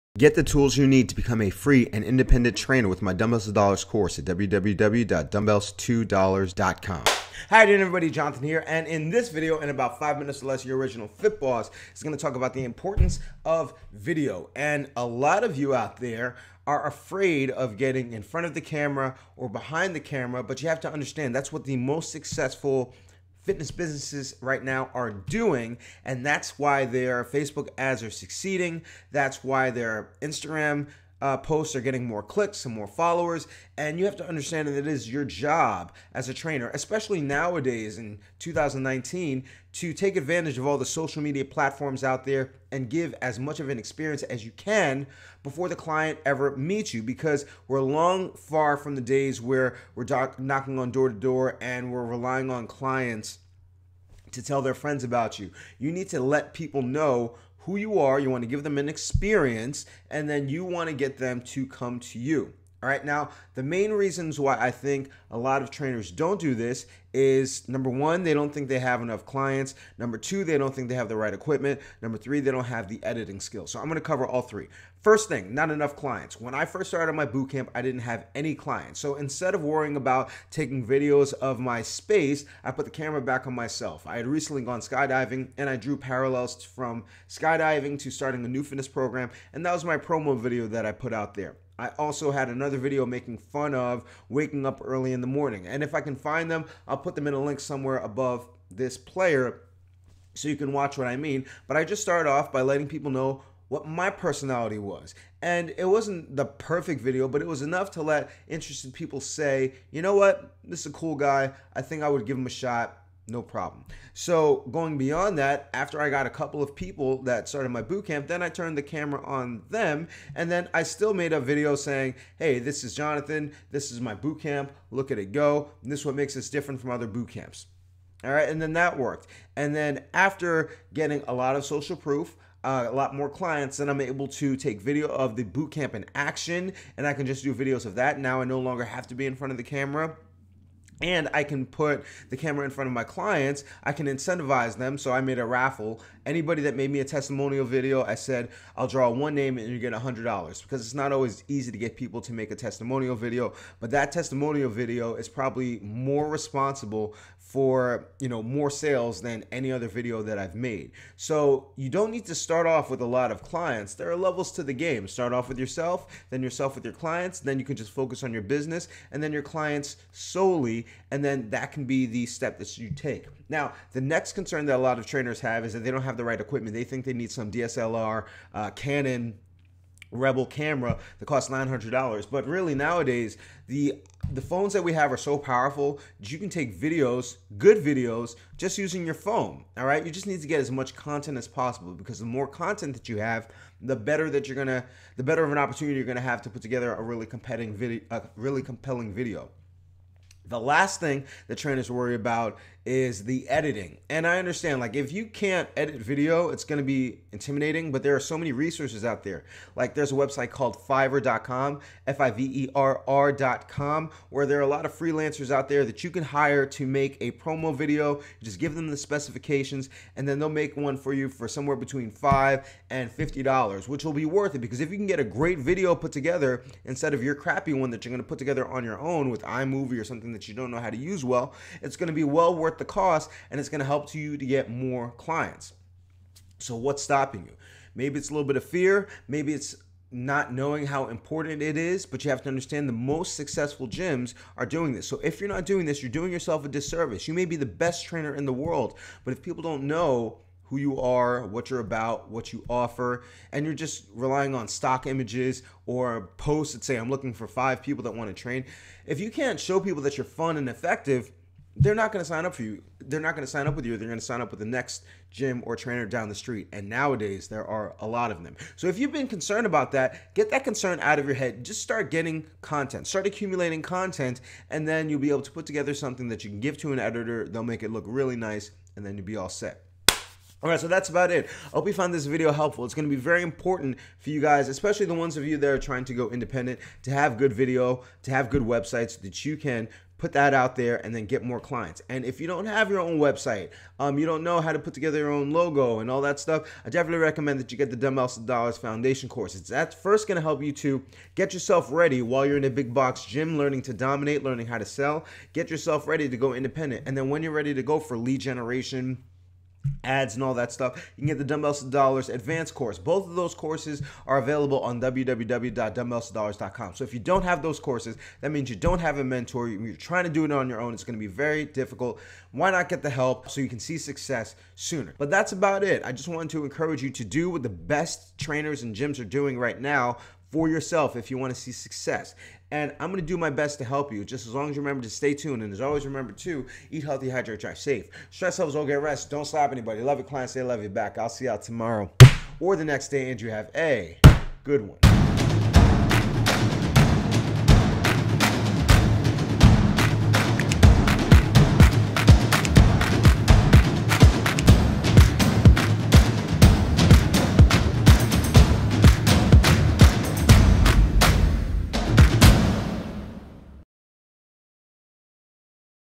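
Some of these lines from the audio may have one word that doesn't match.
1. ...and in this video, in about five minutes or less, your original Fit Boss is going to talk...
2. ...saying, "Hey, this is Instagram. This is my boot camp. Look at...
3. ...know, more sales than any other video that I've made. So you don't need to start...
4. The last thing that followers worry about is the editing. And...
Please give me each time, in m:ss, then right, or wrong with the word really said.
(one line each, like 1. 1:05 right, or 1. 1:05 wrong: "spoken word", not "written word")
1. 0:08 right
2. 2:01 wrong: "Jonathan", not "Instagram"
3. 2:38 right
4. 3:20 wrong: "trainers", not "followers".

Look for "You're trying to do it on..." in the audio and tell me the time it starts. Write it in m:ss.
5:19.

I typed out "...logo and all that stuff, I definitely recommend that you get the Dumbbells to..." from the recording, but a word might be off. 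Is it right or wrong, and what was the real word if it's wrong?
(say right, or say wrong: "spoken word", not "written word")
right.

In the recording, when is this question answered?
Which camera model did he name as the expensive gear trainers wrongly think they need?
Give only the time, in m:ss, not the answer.
2:58.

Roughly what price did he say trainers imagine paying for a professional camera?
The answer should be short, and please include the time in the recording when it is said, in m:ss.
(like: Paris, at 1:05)
$900, at 3:01.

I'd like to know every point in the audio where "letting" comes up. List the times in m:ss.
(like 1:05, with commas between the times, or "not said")
1:42.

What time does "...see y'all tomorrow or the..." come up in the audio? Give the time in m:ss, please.
5:41.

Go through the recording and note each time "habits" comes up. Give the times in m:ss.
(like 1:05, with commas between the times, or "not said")
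not said.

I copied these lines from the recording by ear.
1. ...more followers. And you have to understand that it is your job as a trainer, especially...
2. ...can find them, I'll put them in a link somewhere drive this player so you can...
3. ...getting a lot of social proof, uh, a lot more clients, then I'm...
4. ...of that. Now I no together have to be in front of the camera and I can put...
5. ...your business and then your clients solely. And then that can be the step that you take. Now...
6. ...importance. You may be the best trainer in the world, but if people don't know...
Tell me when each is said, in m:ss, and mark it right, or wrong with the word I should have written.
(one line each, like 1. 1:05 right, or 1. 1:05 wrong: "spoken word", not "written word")
1. 0:32 right
2. 1:36 wrong: "above", not "drive"
3. 2:10 right
4. 2:17 wrong: "longer", not "together"
5. 2:48 right
6. 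4:06 wrong: "disservice", not "importance".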